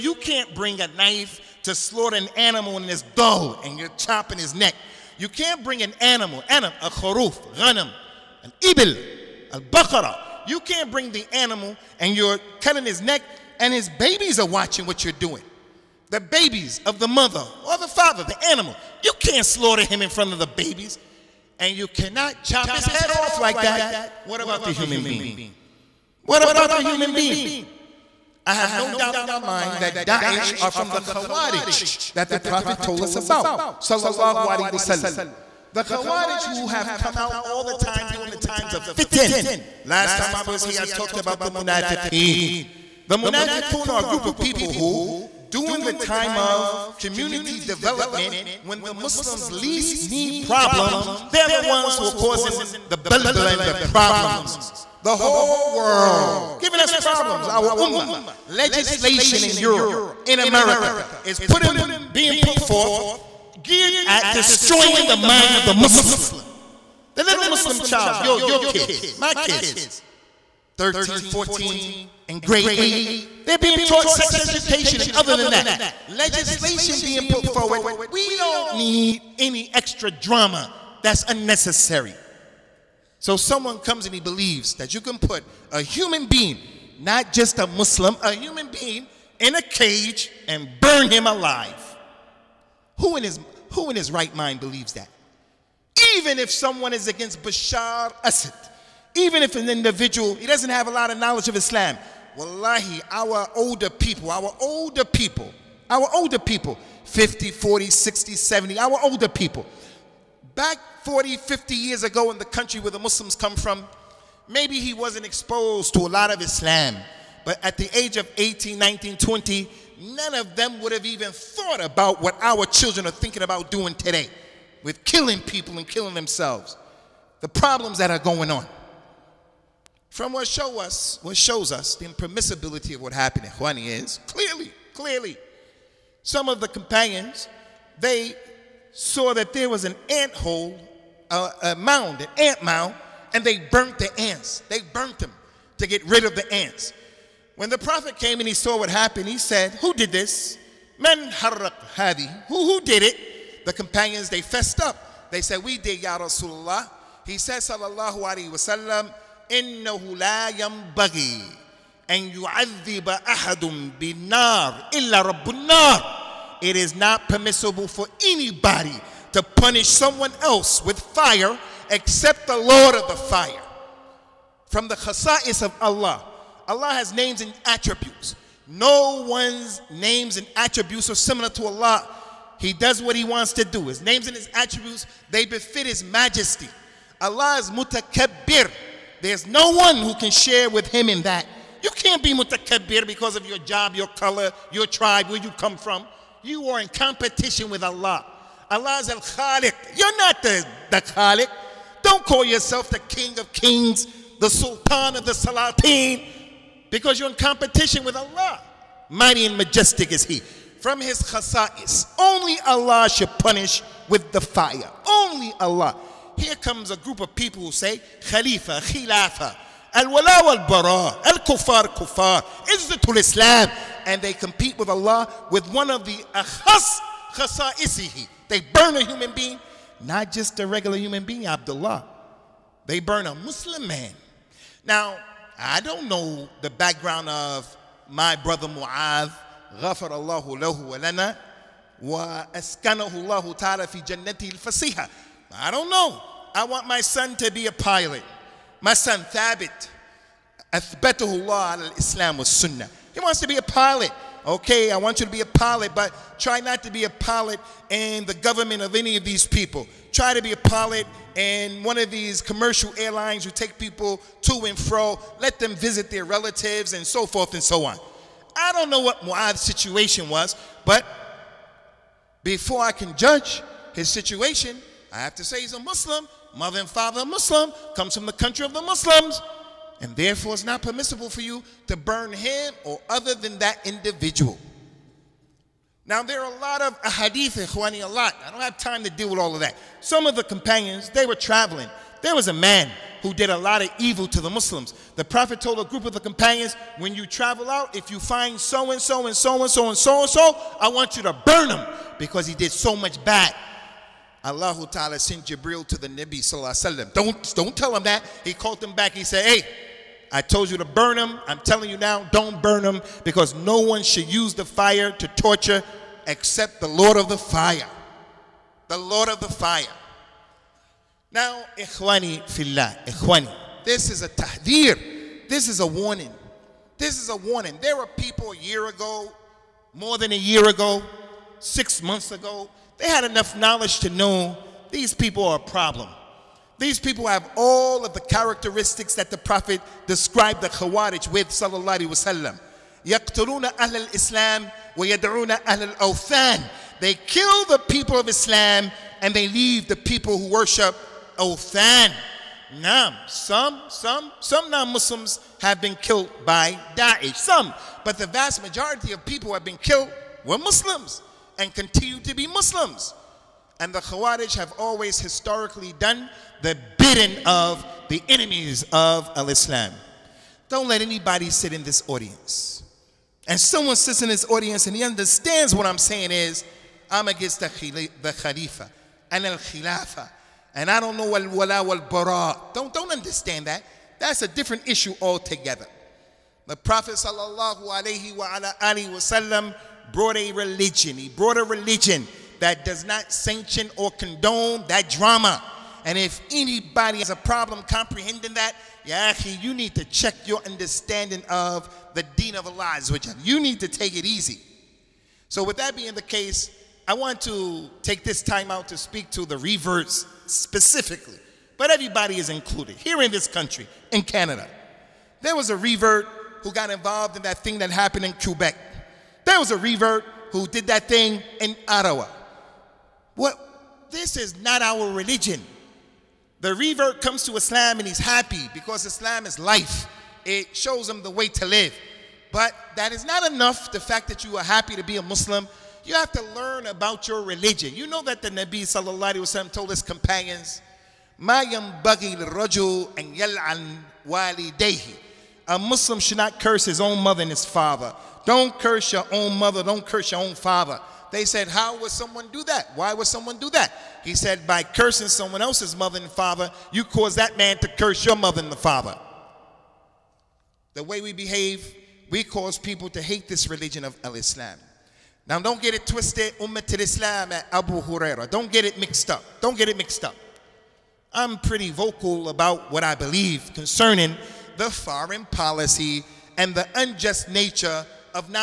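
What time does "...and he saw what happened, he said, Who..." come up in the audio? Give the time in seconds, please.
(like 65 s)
148 s.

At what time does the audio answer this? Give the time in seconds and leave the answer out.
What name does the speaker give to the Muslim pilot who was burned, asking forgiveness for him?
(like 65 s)
238 s.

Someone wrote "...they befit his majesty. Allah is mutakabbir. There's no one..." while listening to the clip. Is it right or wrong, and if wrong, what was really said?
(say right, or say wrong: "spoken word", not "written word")
right.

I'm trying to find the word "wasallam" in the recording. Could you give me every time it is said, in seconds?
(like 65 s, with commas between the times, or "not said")
34 s, 158 s, 307 s, 342 s, 388 s, 439 s.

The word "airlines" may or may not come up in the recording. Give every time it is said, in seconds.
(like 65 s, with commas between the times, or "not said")
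262 s.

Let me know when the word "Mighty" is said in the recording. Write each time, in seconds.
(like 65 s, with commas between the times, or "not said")
209 s.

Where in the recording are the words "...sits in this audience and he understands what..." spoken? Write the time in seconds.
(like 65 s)
373 s.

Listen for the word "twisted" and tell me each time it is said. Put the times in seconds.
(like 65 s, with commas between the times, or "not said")
466 s.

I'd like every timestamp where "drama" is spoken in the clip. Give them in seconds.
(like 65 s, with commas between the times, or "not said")
80 s, 395 s.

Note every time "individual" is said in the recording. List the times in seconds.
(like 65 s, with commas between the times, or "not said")
99 s, 283 s.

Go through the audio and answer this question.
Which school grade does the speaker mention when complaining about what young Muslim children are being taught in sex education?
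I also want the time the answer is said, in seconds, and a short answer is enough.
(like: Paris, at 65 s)
Grade 8, at 72 s.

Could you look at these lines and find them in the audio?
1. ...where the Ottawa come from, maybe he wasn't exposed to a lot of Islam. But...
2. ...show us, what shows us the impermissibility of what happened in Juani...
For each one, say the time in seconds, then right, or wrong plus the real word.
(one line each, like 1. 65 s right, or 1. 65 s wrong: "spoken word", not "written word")
1. 112 s wrong: "Muslims", not "Ottawa"
2. 130 s right.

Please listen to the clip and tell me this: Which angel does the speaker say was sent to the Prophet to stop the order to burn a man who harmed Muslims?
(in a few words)
Jibril.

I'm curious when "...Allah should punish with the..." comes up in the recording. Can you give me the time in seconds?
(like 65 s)
212 s.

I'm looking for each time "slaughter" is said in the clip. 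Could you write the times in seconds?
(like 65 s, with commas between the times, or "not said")
1 s, 19 s.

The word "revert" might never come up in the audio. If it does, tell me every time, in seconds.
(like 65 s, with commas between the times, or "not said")
409 s, 415 s, 419 s, 426 s.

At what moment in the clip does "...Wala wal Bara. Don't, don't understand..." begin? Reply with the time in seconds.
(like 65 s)
381 s.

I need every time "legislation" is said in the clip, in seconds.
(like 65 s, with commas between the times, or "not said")
58 s, 76 s.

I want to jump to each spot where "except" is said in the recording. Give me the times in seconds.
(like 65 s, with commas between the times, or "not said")
171 s, 316 s.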